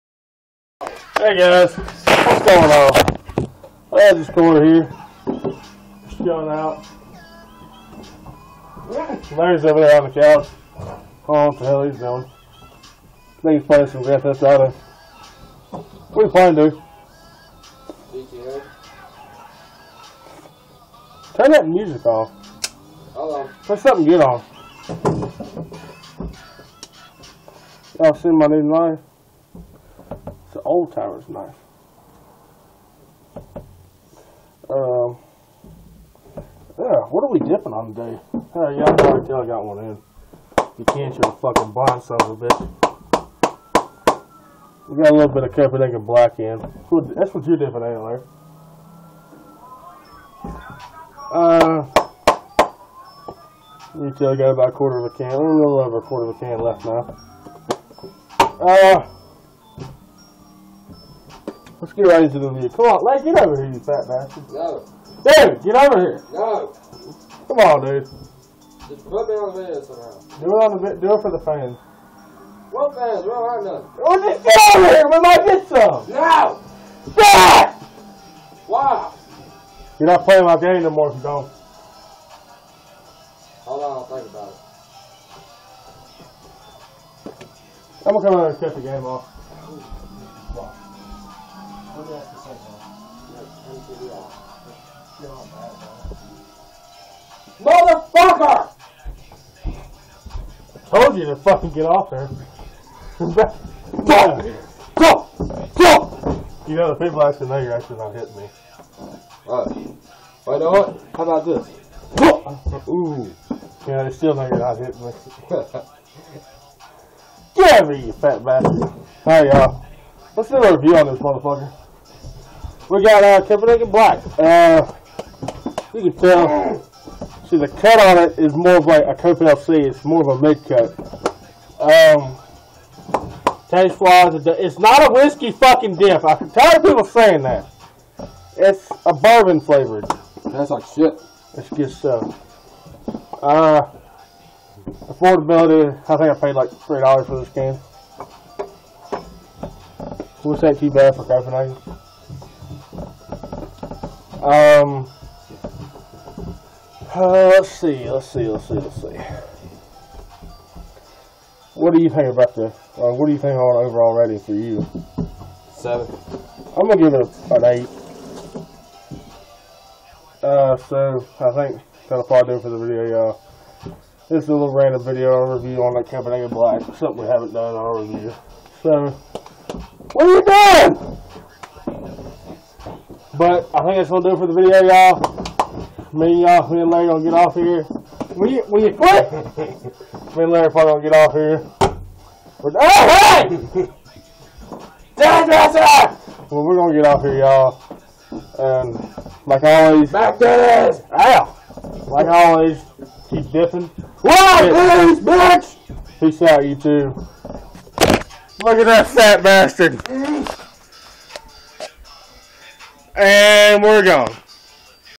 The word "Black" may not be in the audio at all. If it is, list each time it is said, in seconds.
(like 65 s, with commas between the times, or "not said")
46 s, 123 s, 176 s.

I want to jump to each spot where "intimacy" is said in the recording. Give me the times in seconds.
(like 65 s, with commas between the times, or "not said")
not said.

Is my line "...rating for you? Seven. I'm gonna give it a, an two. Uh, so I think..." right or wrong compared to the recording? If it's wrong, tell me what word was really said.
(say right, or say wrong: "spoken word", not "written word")
wrong: "eight", not "two".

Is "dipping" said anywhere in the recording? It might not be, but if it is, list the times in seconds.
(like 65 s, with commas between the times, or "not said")
37 s, 47 s, 203 s.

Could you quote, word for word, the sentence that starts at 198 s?
And like always, back to this.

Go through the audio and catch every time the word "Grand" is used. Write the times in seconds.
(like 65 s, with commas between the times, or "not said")
14 s.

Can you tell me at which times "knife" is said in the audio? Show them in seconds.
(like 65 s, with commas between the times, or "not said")
31 s.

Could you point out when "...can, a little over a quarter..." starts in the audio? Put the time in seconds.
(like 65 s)
55 s.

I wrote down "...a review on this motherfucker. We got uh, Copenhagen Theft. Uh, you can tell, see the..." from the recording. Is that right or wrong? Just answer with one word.
wrong.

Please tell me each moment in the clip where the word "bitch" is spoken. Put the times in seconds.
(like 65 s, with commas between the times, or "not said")
42 s, 205 s.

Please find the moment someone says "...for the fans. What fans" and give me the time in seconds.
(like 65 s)
71 s.